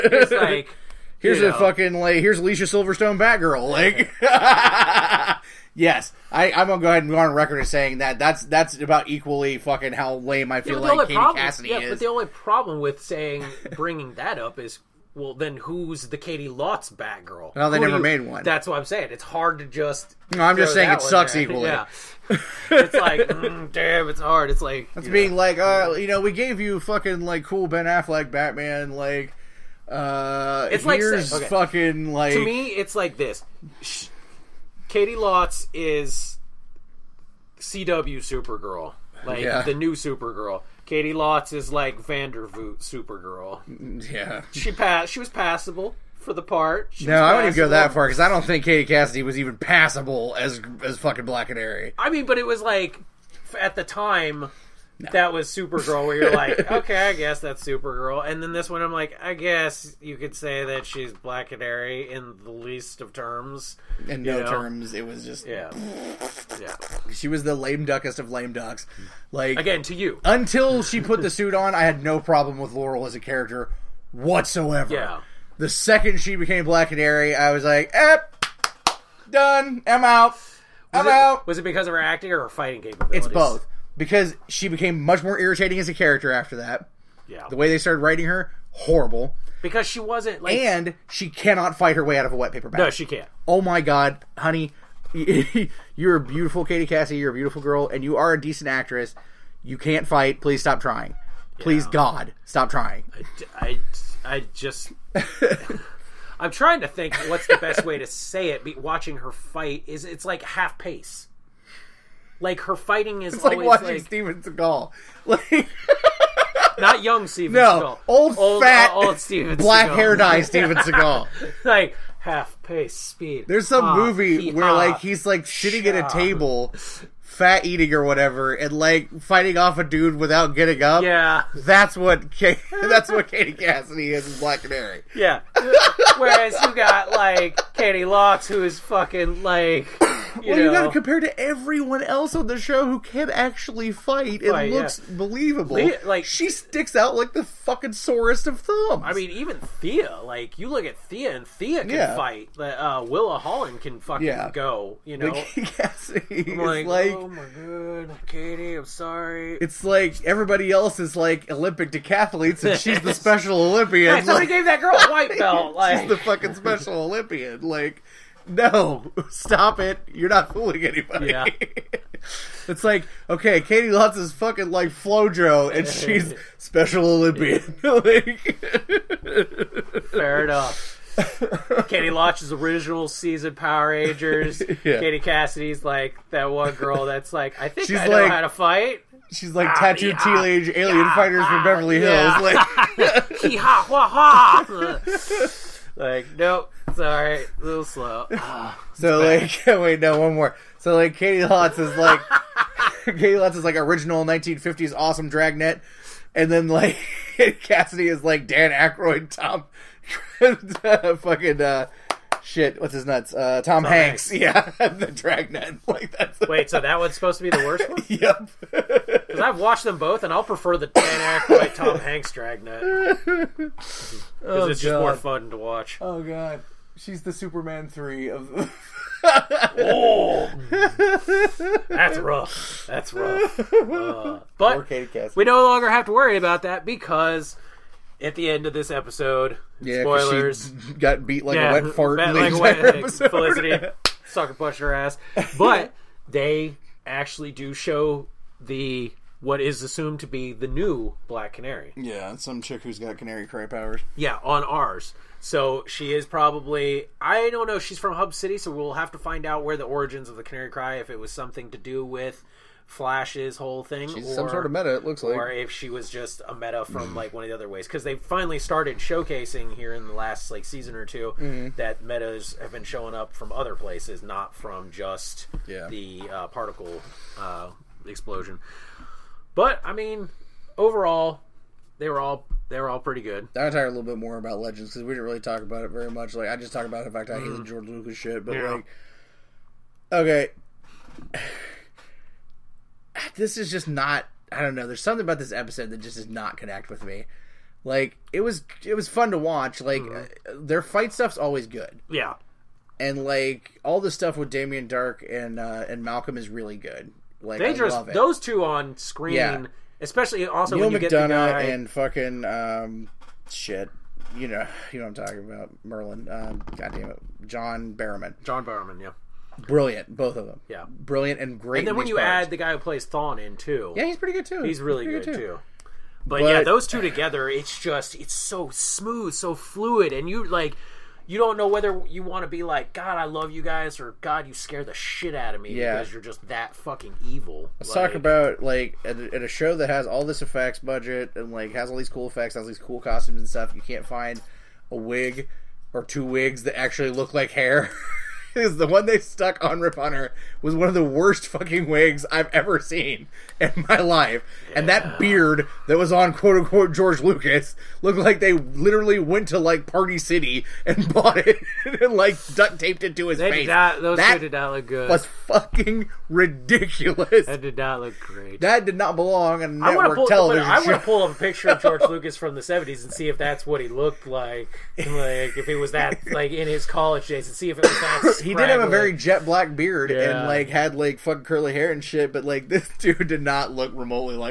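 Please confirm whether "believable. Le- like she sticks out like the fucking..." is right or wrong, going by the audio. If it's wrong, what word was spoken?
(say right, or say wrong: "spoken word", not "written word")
right.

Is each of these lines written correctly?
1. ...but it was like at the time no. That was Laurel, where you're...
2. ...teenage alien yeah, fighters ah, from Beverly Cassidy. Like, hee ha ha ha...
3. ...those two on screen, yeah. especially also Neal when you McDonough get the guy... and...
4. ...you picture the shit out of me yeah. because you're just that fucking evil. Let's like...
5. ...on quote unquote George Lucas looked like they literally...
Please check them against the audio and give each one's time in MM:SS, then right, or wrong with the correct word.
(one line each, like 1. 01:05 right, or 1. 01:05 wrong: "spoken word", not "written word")
1. 00:52 wrong: "Supergirl", not "Laurel"
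2. 03:10 wrong: "Hills", not "Cassidy"
3. 05:08 right
4. 05:34 wrong: "scare", not "picture"
5. 05:56 right.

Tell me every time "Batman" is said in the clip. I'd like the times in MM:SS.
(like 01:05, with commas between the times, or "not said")
00:28.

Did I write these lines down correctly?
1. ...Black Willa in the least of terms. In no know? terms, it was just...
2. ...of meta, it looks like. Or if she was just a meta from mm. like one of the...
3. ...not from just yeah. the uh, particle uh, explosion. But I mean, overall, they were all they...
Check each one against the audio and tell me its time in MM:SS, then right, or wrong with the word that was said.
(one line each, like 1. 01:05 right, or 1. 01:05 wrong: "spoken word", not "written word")
1. 01:01 wrong: "Canary", not "Willa"
2. 04:24 right
3. 04:34 right.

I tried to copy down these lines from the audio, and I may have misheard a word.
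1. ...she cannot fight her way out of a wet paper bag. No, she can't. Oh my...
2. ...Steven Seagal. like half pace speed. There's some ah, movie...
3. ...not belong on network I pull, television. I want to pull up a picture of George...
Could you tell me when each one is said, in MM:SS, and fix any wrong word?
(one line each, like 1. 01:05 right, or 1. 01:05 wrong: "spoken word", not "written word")
1. 01:31 right
2. 02:00 right
3. 06:08 right.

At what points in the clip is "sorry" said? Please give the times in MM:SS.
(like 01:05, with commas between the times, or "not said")
02:38, 03:16.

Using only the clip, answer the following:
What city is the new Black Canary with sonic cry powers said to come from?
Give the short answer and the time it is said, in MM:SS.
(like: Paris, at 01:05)
Hub City, at 04:18.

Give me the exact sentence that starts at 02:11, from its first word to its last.
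Yeah, that's what that's what Katie Cassidy is in Black Canary.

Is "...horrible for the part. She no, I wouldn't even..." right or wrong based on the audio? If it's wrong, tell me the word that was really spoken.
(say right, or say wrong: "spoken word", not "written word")
wrong: "passable", not "horrible".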